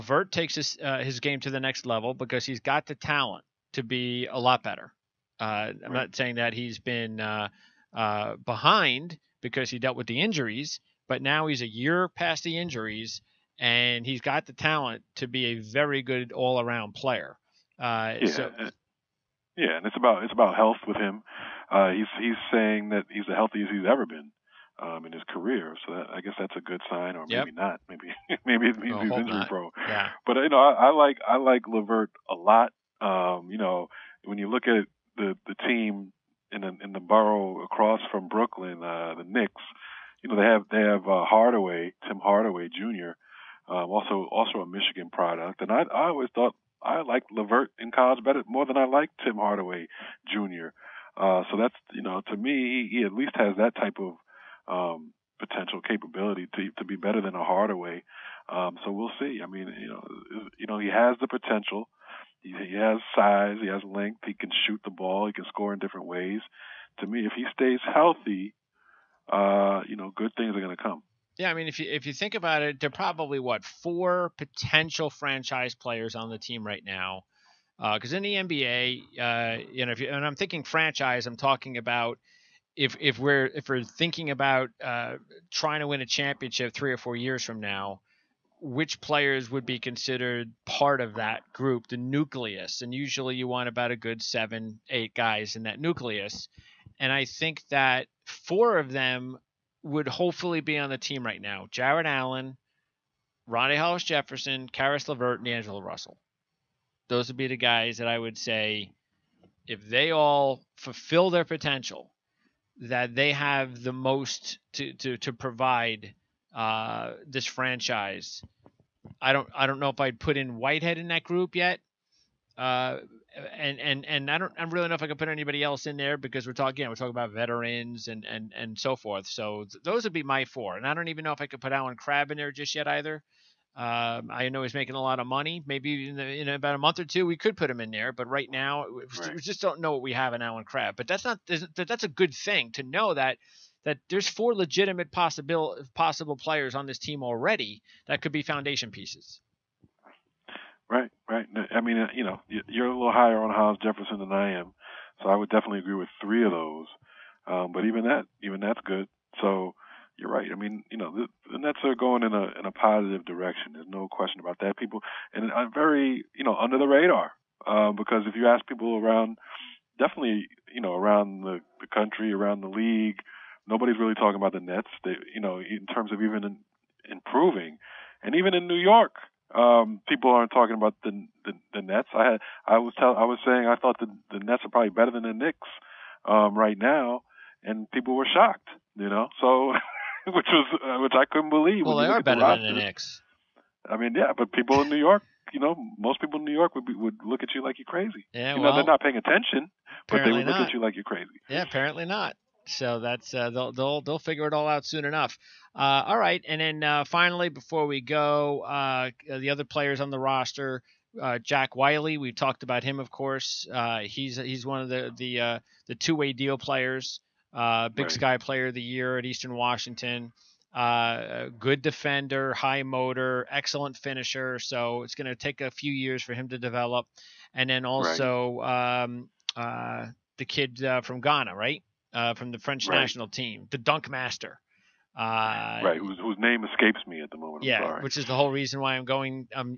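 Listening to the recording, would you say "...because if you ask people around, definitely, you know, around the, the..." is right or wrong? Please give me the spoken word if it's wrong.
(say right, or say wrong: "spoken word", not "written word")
right.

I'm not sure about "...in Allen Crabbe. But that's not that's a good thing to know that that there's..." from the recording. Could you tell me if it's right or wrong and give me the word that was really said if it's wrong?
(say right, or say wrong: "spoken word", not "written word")
right.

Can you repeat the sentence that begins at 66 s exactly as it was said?
To me, if he stays healthy, uh, you know, good things are going to come.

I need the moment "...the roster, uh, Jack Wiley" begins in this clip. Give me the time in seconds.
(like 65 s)
210 s.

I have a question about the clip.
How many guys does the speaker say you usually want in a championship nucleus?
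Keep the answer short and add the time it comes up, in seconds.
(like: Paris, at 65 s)
7 or 8, at 94 s.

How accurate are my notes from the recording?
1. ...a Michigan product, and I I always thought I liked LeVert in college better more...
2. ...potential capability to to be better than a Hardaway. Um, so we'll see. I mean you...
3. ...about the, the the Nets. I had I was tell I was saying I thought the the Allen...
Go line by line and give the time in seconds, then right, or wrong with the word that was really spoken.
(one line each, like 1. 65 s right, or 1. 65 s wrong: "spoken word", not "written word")
1. 44 s right
2. 55 s right
3. 180 s wrong: "Nets", not "Allen".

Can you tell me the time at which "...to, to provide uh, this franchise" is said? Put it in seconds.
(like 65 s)
114 s.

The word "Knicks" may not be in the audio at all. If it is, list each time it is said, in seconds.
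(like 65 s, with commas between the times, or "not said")
39 s, 185 s, 192 s.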